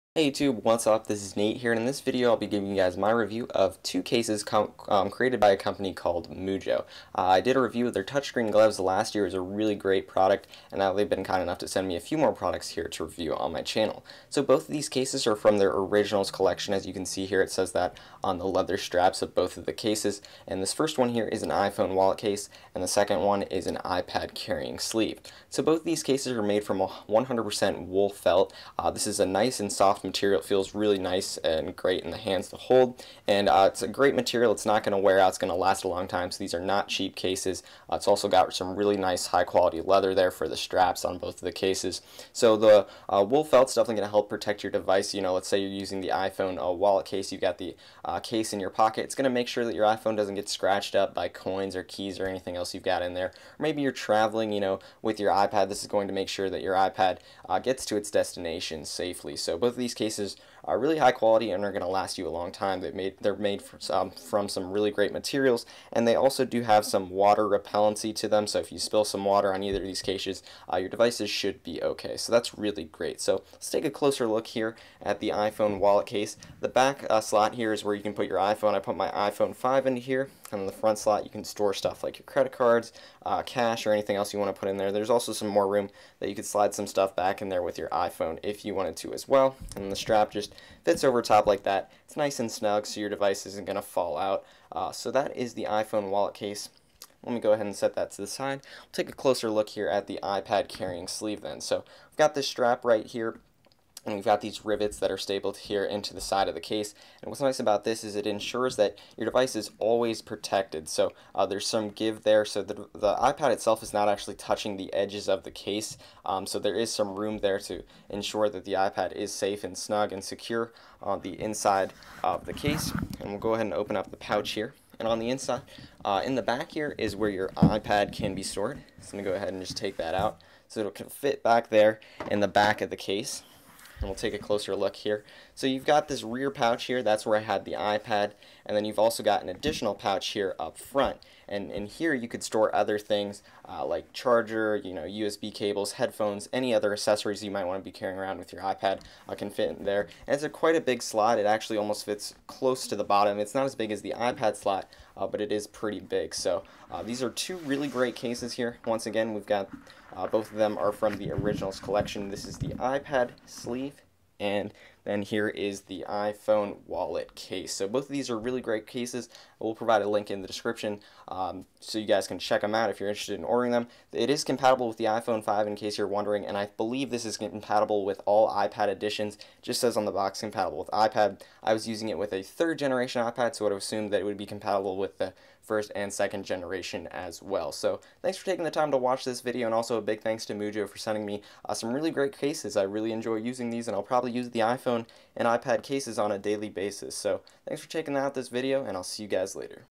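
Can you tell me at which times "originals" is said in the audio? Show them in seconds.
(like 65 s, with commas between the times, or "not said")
15 s, 161 s.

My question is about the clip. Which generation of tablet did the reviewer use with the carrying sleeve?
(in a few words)
Third generation.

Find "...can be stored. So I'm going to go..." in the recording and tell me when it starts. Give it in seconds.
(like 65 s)
128 s.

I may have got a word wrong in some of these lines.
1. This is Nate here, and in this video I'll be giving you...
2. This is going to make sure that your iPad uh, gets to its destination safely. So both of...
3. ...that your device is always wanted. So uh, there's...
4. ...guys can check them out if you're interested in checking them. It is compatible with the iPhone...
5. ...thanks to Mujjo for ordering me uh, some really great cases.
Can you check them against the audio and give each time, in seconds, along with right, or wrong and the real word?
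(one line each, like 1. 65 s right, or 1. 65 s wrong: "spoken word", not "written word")
1. 1 s right
2. 55 s right
3. 108 s wrong: "protected", not "wanted"
4. 172 s wrong: "ordering", not "checking"
5. 190 s wrong: "sending", not "ordering".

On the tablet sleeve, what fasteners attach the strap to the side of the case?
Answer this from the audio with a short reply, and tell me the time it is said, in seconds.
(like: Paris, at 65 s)
Rivets, at 104 s.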